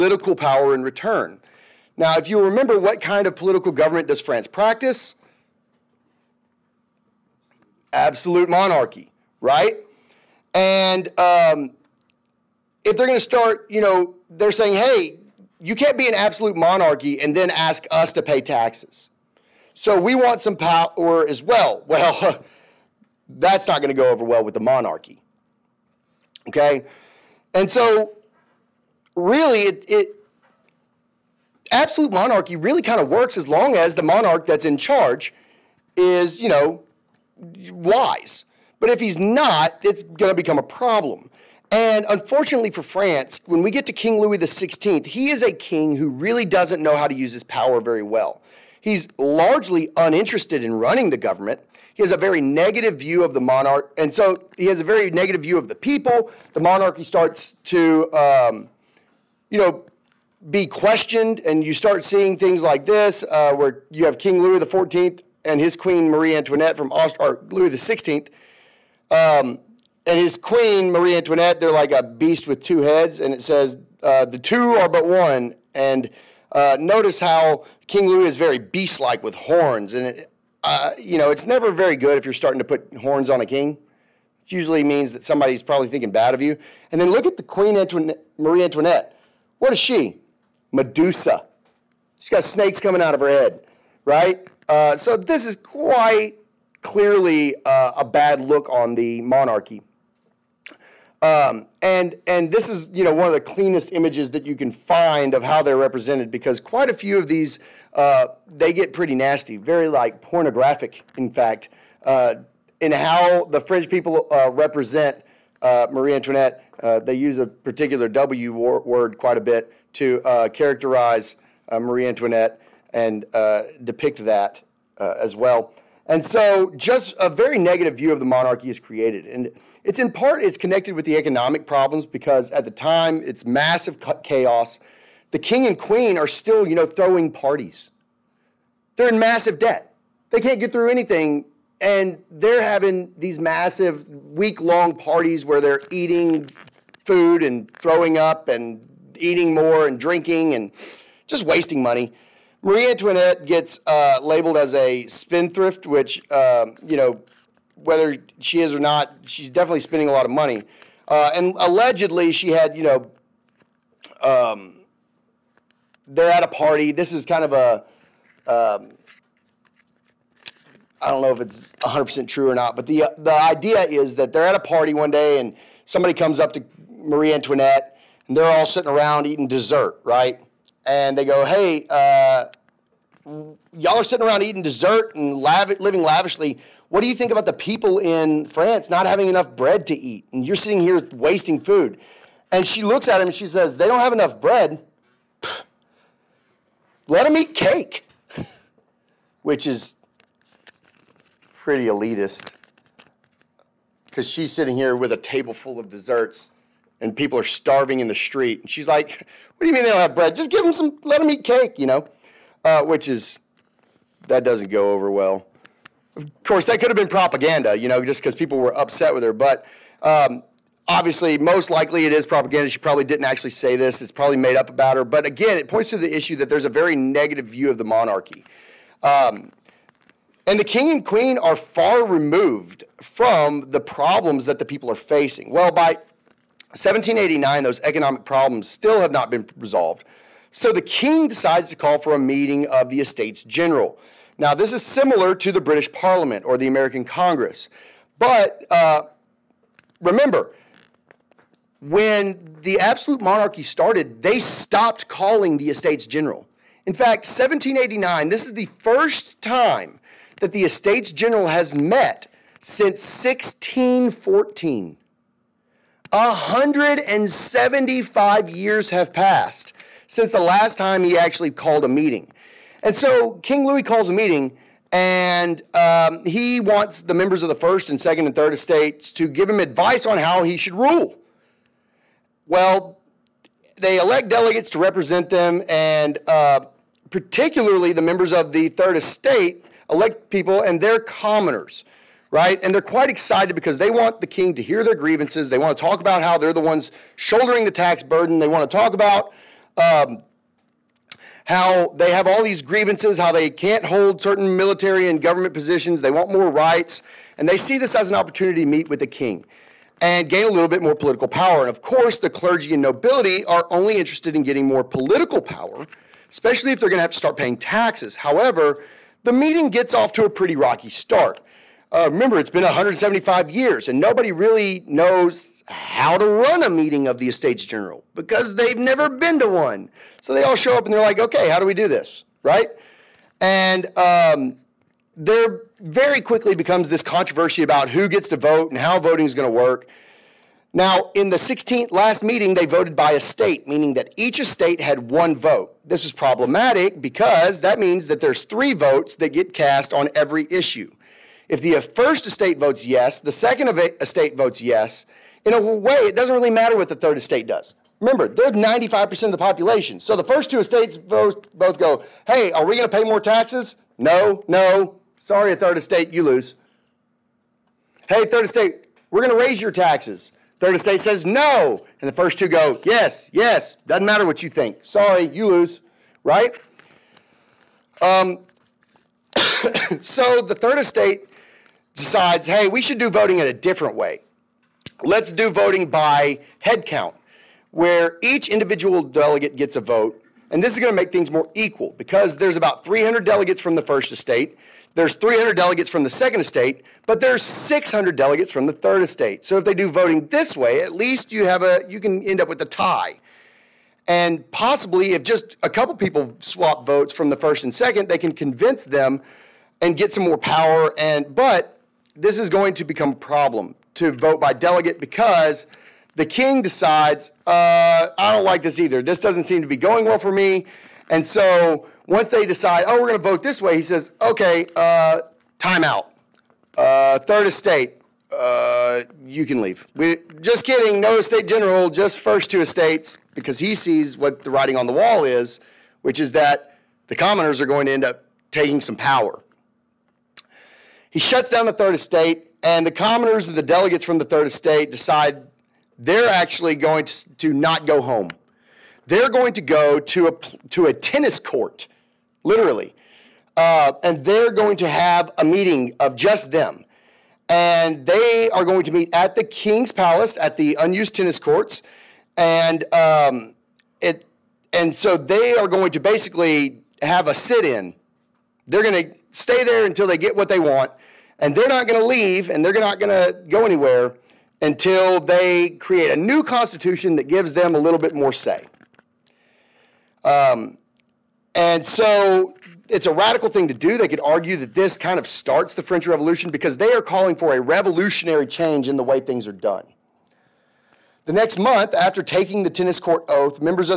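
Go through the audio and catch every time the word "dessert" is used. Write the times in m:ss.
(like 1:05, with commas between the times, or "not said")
2:59, 3:04, 3:25.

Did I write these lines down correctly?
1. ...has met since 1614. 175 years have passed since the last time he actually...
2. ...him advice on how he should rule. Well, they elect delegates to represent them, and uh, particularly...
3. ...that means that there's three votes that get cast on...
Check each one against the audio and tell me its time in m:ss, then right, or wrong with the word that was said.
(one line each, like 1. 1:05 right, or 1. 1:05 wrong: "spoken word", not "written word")
1. 4:21 right
2. 4:39 right
3. 5:47 right.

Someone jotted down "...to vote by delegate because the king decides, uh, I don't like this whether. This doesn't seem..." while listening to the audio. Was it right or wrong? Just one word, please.
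wrong.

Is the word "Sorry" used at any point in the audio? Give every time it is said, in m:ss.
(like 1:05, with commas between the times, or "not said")
6:05, 6:14.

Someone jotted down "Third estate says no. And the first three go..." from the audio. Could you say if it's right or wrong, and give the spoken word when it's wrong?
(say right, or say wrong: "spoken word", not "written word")
wrong: "two", not "three".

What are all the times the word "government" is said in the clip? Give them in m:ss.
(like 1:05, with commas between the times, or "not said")
0:03, 0:51, 5:05.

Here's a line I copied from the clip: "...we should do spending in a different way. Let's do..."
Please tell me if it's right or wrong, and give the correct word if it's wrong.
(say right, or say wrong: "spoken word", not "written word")
wrong: "voting", not "spending".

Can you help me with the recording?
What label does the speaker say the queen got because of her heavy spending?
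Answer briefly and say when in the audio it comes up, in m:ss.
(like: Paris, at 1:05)
Spendthrift, at 2:35.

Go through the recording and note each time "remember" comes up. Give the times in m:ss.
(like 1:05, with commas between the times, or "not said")
0:02, 4:10, 5:22, 5:58.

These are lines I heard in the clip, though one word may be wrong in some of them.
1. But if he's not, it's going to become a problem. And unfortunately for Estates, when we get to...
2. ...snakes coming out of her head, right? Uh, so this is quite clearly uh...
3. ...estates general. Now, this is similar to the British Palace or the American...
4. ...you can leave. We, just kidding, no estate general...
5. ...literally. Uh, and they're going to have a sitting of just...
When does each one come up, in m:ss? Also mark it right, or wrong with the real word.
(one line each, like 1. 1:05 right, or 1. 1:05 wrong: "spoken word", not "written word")
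1. 0:38 wrong: "France", not "Estates"
2. 1:32 right
3. 4:02 wrong: "Parliament", not "Palace"
4. 7:09 right
5. 7:32 wrong: "meeting", not "sitting".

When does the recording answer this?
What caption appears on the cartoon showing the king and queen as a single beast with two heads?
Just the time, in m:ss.
1:14.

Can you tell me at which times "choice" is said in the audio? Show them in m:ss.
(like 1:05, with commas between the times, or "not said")
not said.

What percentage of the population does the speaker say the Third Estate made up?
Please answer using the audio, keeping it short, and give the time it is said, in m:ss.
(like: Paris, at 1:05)
95%, at 5:58.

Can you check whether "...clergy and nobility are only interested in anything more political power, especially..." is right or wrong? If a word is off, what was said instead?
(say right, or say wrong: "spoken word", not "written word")
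wrong: "getting", not "anything".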